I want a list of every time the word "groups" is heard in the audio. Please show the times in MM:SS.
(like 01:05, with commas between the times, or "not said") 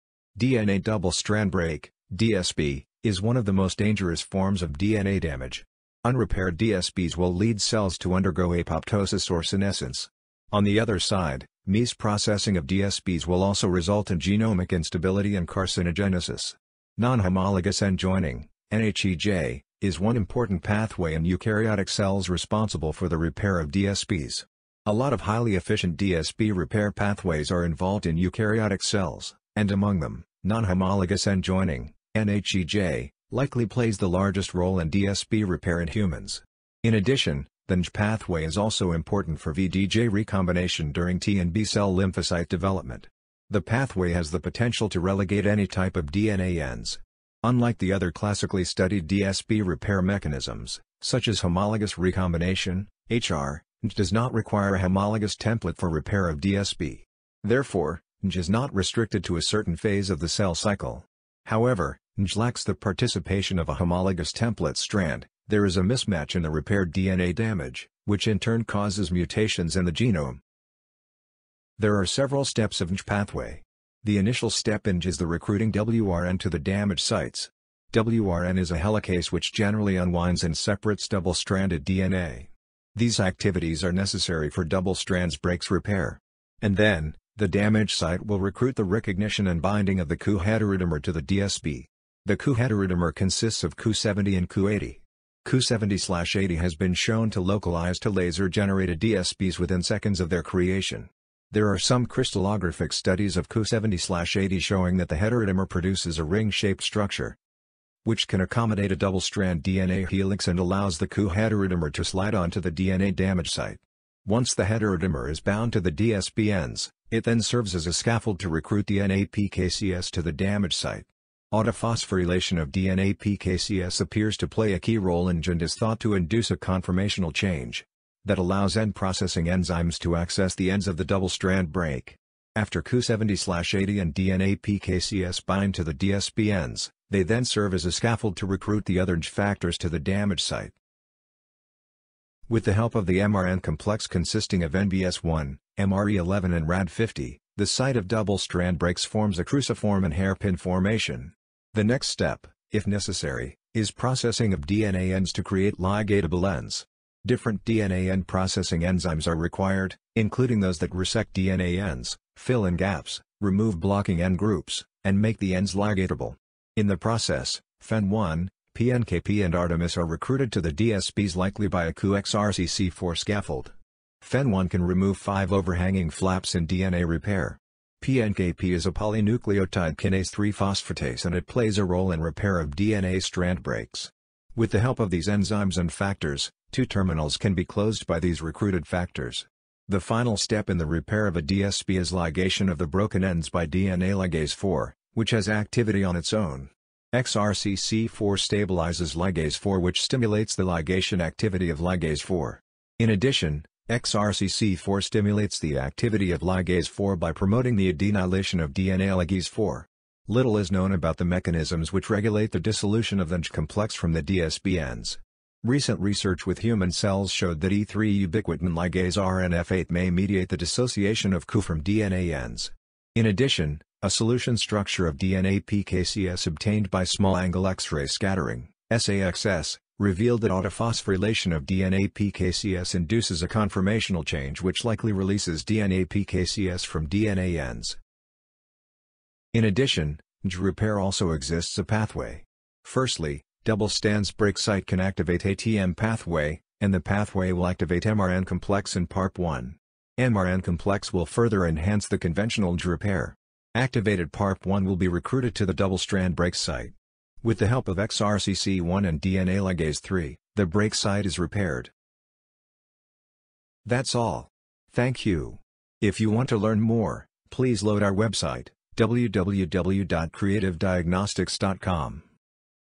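02:44.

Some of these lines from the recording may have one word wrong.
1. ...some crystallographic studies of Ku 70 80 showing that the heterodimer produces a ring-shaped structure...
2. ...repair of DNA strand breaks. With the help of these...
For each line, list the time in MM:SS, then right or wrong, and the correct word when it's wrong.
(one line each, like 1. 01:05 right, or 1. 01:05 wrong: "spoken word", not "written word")
1. 01:41 right
2. 03:02 right.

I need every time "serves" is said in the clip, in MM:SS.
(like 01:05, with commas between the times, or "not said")
01:57, 02:17.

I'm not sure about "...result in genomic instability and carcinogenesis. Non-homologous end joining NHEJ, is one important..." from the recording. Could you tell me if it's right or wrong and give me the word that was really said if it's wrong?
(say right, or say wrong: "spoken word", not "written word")
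right.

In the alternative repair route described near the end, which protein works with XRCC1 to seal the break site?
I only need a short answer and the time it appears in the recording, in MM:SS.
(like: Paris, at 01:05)
DNA ligase 3, at 04:19.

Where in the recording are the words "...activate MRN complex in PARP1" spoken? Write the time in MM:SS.
04:07.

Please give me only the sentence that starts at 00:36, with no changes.
In addition, the NJ pathway is also important for VDJ recombination during T and B cell lymphocyte development.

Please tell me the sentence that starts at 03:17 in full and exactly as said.
XRCC4 stabilizes ligase 4 which stimulates the ligation activity of ligase 4.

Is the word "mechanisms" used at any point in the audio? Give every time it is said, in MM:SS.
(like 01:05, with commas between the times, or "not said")
00:50, 03:31.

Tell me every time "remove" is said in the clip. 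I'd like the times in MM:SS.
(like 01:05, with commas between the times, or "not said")
02:43, 02:54.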